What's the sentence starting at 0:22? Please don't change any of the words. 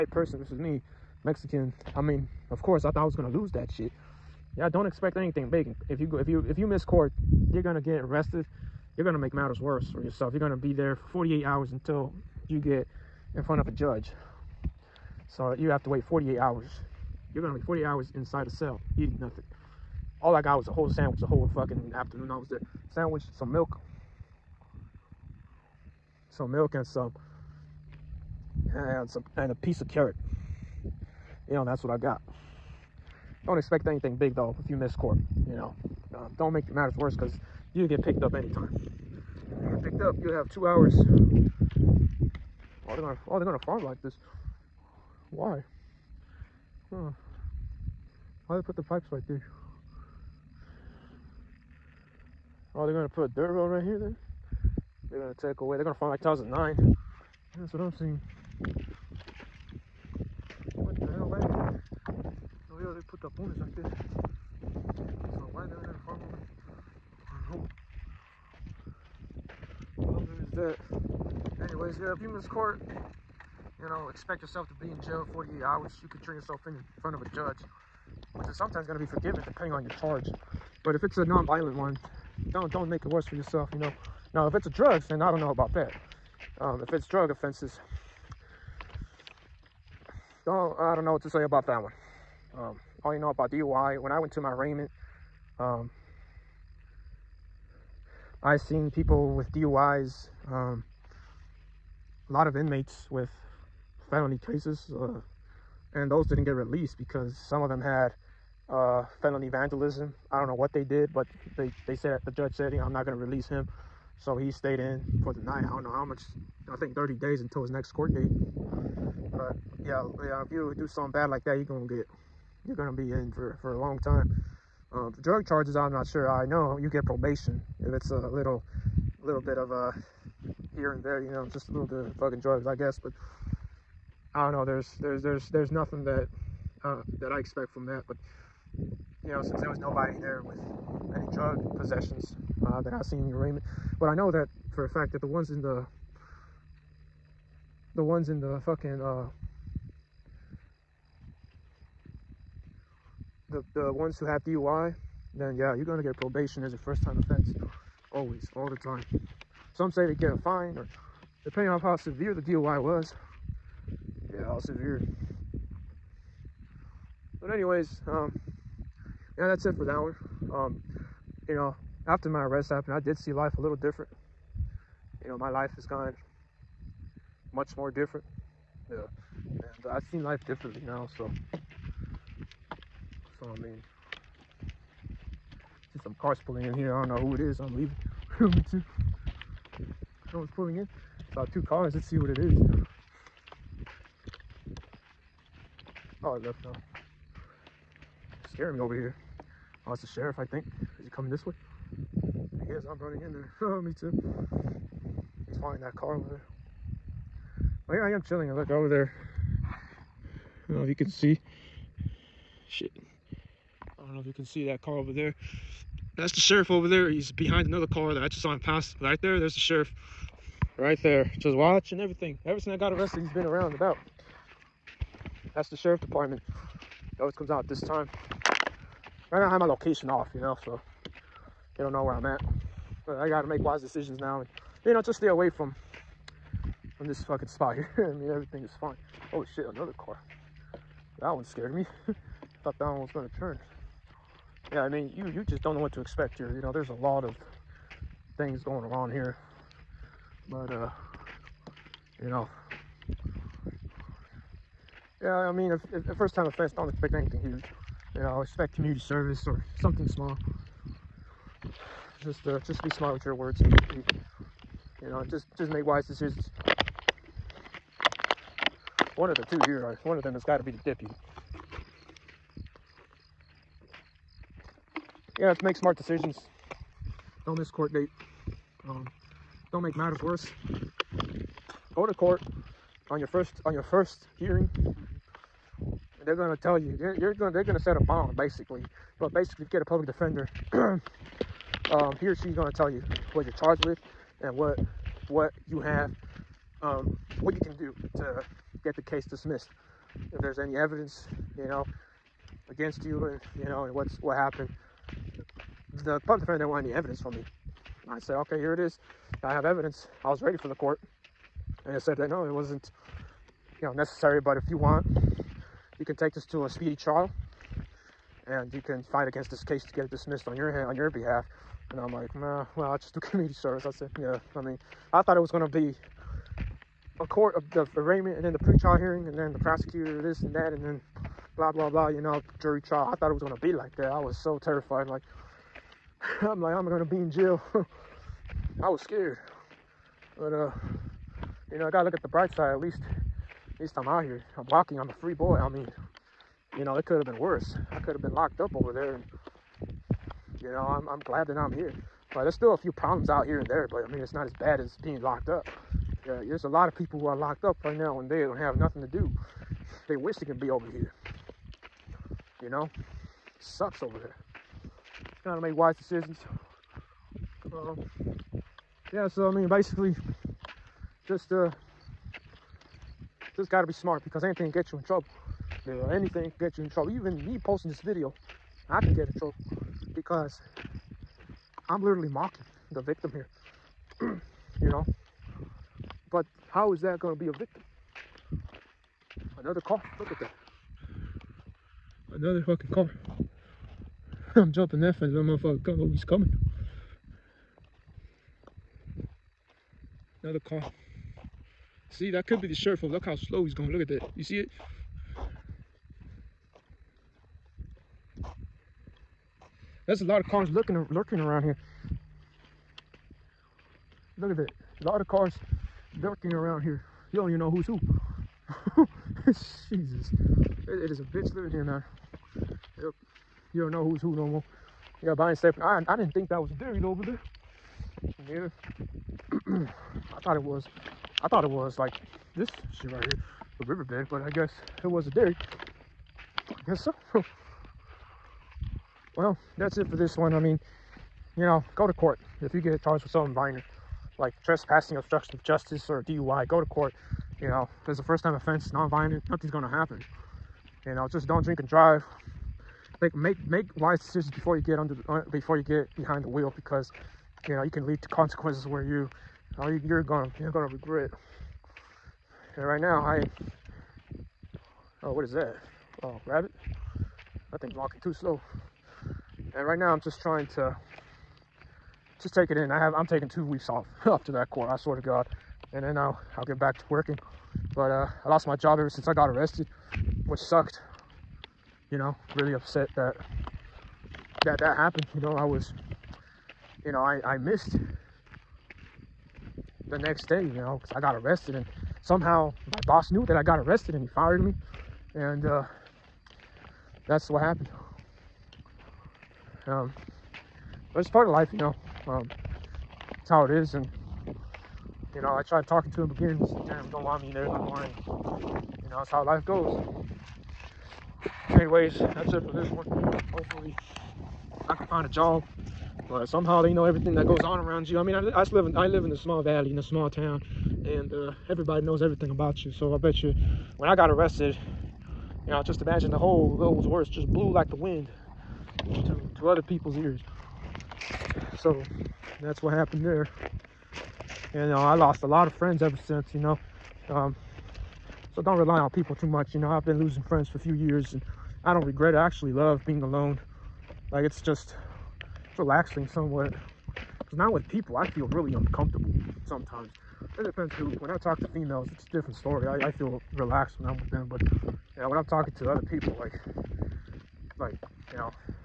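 Sandwich, some milk, some milk and some and some and a piece of carrot.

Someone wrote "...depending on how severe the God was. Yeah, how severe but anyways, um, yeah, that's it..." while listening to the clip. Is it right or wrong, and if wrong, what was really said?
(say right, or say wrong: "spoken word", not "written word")
wrong: "DUI", not "God".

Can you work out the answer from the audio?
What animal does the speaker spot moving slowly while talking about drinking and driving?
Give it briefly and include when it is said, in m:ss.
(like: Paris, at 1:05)
rabbit, at 7:46.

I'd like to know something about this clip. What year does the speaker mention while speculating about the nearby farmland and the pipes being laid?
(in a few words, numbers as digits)
2009.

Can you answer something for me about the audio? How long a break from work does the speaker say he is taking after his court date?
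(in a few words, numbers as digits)
2 weeks.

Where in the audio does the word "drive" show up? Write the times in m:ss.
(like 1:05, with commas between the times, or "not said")
7:31.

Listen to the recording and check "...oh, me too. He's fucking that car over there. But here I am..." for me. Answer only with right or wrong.
wrong.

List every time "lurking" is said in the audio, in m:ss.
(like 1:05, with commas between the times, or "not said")
6:51, 6:56.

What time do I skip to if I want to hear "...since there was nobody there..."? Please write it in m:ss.
2:19.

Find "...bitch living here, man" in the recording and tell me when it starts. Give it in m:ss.
7:01.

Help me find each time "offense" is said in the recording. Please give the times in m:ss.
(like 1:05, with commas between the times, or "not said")
1:27, 2:37, 4:16, 7:28.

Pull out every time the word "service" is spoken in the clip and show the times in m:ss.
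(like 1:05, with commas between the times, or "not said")
4:18, 5:23.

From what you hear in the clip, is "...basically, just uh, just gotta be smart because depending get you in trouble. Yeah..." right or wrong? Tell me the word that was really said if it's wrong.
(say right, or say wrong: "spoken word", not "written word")
wrong: "anything", not "depending".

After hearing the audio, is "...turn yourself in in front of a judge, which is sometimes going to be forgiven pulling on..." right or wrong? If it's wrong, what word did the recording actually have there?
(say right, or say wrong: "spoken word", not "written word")
wrong: "depending", not "pulling".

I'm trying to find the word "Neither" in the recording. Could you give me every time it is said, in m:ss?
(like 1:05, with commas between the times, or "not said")
7:08.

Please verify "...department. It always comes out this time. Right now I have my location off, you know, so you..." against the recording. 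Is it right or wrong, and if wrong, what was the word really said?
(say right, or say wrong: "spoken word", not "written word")
right.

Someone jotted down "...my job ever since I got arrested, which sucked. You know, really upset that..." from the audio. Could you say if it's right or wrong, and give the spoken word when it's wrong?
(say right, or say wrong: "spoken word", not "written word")
right.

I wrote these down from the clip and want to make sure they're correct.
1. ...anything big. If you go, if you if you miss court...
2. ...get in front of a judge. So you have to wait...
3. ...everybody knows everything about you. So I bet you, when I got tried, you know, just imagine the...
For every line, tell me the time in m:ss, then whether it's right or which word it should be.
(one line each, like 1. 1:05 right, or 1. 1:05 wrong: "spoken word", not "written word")
1. 0:05 right
2. 0:12 right
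3. 8:41 wrong: "arrested", not "tried".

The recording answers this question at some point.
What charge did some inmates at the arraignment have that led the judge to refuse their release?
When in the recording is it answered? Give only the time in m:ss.
1:49.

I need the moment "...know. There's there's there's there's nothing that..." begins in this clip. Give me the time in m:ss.
2:14.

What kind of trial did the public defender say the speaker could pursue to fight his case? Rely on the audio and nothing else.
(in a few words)
speedy trial.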